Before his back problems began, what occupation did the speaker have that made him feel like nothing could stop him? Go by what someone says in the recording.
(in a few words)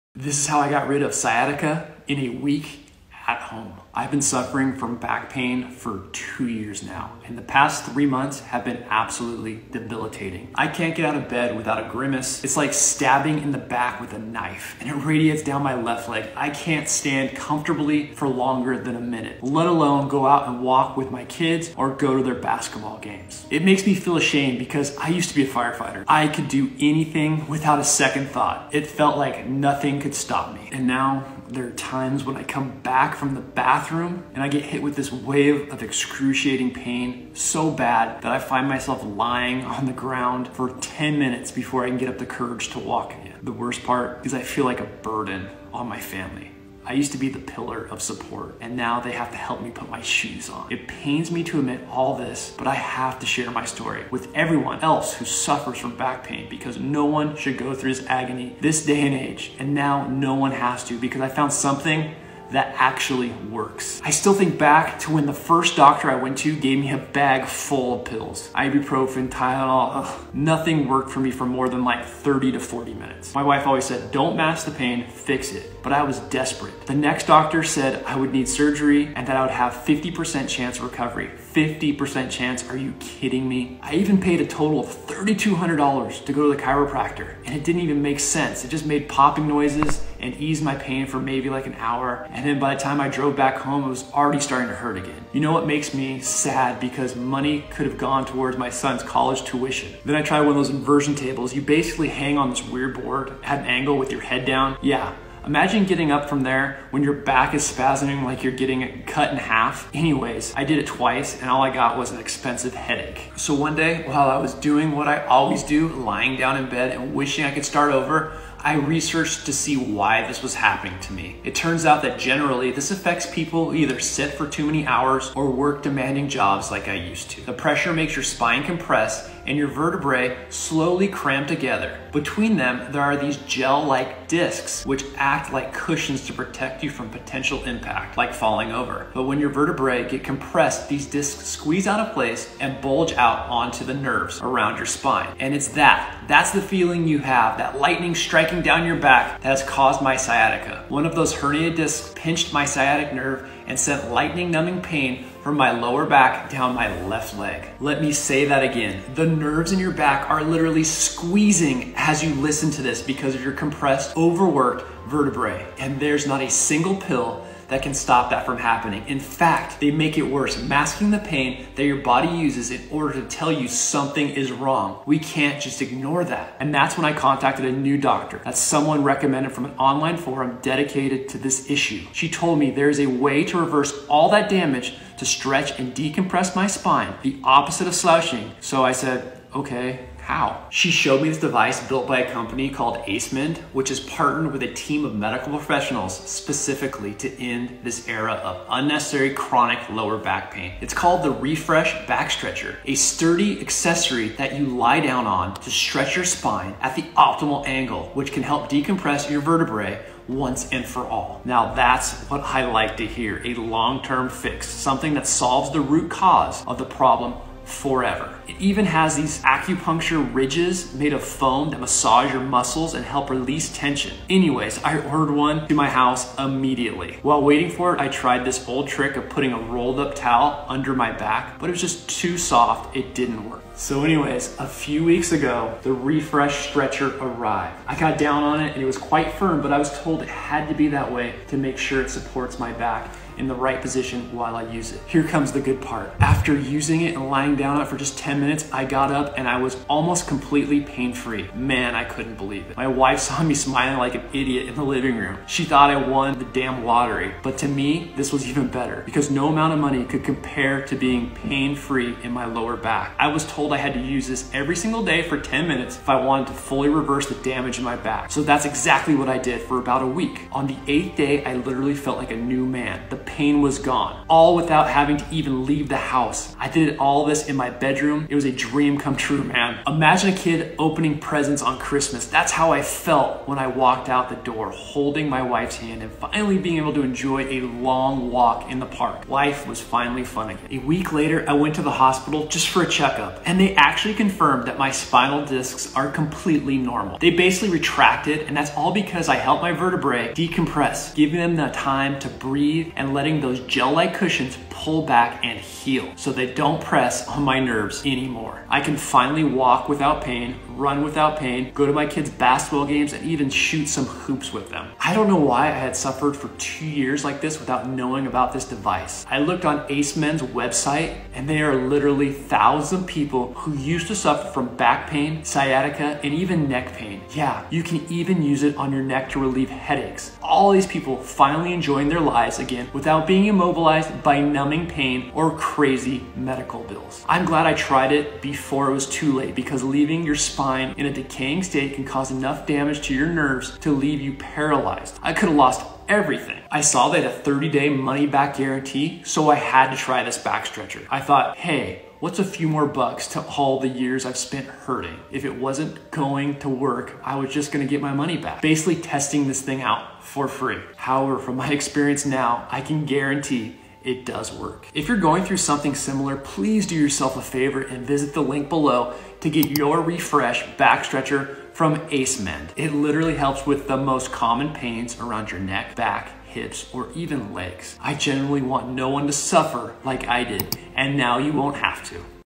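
firefighter.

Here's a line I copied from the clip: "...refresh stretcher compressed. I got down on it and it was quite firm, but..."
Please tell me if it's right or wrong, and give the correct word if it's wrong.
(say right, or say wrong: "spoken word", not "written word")
wrong: "arrived", not "compressed".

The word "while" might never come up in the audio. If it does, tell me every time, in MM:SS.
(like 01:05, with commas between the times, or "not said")
01:54, 03:47, 04:04.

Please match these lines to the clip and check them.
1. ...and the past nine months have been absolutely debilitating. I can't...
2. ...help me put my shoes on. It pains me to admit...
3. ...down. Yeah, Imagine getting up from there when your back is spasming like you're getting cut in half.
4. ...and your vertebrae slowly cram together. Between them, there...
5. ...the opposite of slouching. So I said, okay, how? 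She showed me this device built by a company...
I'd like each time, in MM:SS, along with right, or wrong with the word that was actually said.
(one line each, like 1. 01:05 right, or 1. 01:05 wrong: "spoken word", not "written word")
1. 00:07 wrong: "three", not "nine"
2. 00:49 right
3. 01:44 right
4. 02:09 right
5. 03:07 right.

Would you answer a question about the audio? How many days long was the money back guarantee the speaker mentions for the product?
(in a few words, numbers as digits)
30.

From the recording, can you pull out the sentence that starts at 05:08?
I can finally walk without pain, run without pain, go to my kids' basketball games, and even shoot some hoops with them.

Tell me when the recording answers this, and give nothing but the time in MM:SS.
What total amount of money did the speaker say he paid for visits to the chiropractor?
01:24.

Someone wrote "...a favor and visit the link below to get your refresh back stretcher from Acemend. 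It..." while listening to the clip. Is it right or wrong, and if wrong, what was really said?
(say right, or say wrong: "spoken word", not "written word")
right.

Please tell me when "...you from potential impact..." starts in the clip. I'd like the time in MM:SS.
02:16.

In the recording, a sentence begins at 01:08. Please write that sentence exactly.
Ibuprofen, Tylenol, ugh, nothing worked for me for more than like 30 to 40 minutes.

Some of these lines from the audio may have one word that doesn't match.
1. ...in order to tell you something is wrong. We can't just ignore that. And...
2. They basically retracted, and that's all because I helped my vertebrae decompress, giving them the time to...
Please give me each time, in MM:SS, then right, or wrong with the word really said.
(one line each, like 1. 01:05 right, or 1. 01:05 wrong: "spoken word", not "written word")
1. 02:52 right
2. 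04:57 right.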